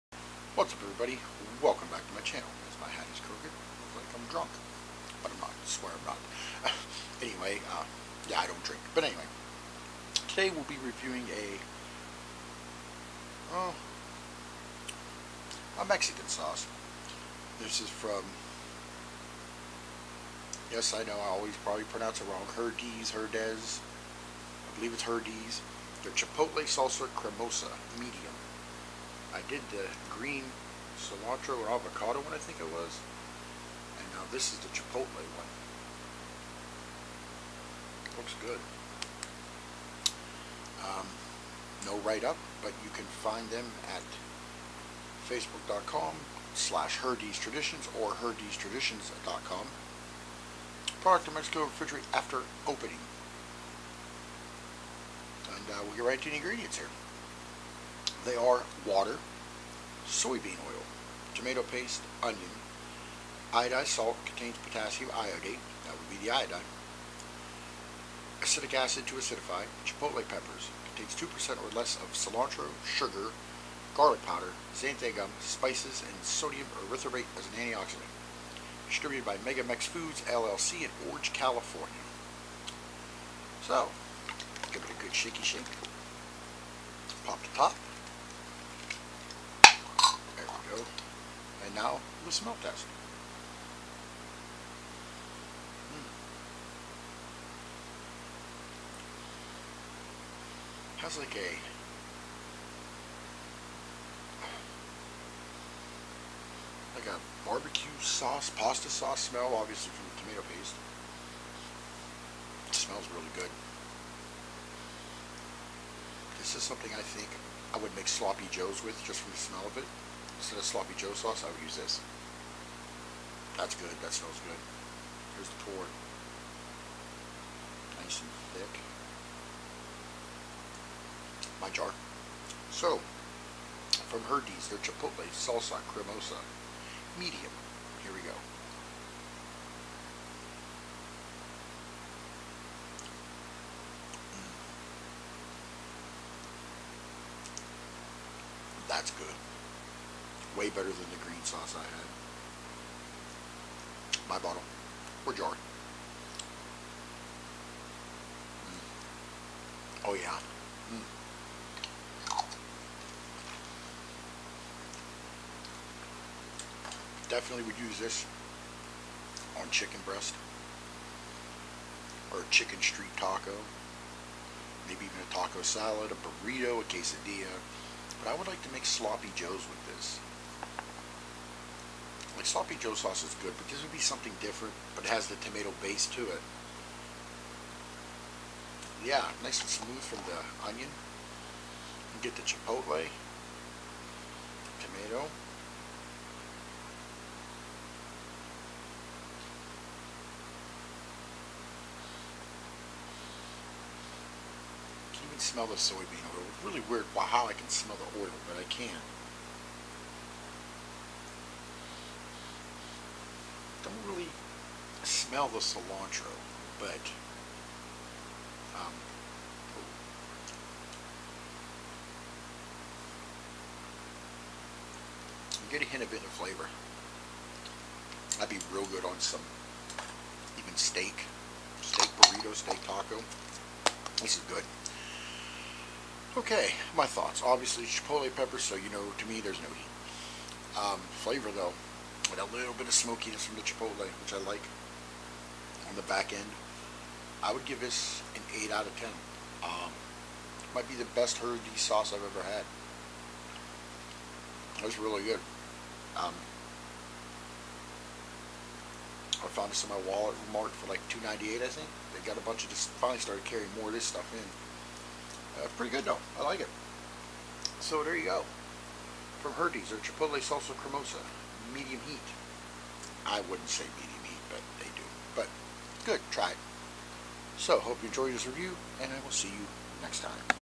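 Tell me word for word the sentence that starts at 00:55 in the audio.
And uh, we'll get right to the ingredients here.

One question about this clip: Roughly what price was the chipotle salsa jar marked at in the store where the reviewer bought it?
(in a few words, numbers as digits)
$2.98.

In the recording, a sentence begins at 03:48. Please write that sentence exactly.
That'd be real good on some even steak, steak burrito, steak taco.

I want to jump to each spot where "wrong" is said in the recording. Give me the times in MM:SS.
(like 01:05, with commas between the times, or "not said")
00:22.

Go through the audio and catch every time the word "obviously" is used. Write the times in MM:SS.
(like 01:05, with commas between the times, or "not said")
01:49, 03:57.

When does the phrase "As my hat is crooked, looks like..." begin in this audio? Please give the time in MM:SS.
00:02.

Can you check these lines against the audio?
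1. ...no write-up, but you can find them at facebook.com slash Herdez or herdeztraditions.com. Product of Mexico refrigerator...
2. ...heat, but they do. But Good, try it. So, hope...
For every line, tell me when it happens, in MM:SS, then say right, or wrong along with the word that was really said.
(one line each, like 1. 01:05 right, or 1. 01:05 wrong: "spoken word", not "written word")
1. 00:41 right
2. 04:34 right.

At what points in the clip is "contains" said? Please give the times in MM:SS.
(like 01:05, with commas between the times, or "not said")
01:04, 01:10.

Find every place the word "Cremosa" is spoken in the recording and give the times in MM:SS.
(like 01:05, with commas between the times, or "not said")
00:27, 02:15, 04:30.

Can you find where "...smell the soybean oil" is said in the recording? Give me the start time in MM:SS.
03:25.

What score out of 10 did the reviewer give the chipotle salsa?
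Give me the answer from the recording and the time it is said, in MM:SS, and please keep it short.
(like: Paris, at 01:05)
8, at 04:08.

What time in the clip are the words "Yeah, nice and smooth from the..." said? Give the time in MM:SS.
03:09.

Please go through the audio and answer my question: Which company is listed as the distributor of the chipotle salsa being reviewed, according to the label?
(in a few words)
Megamex Foods.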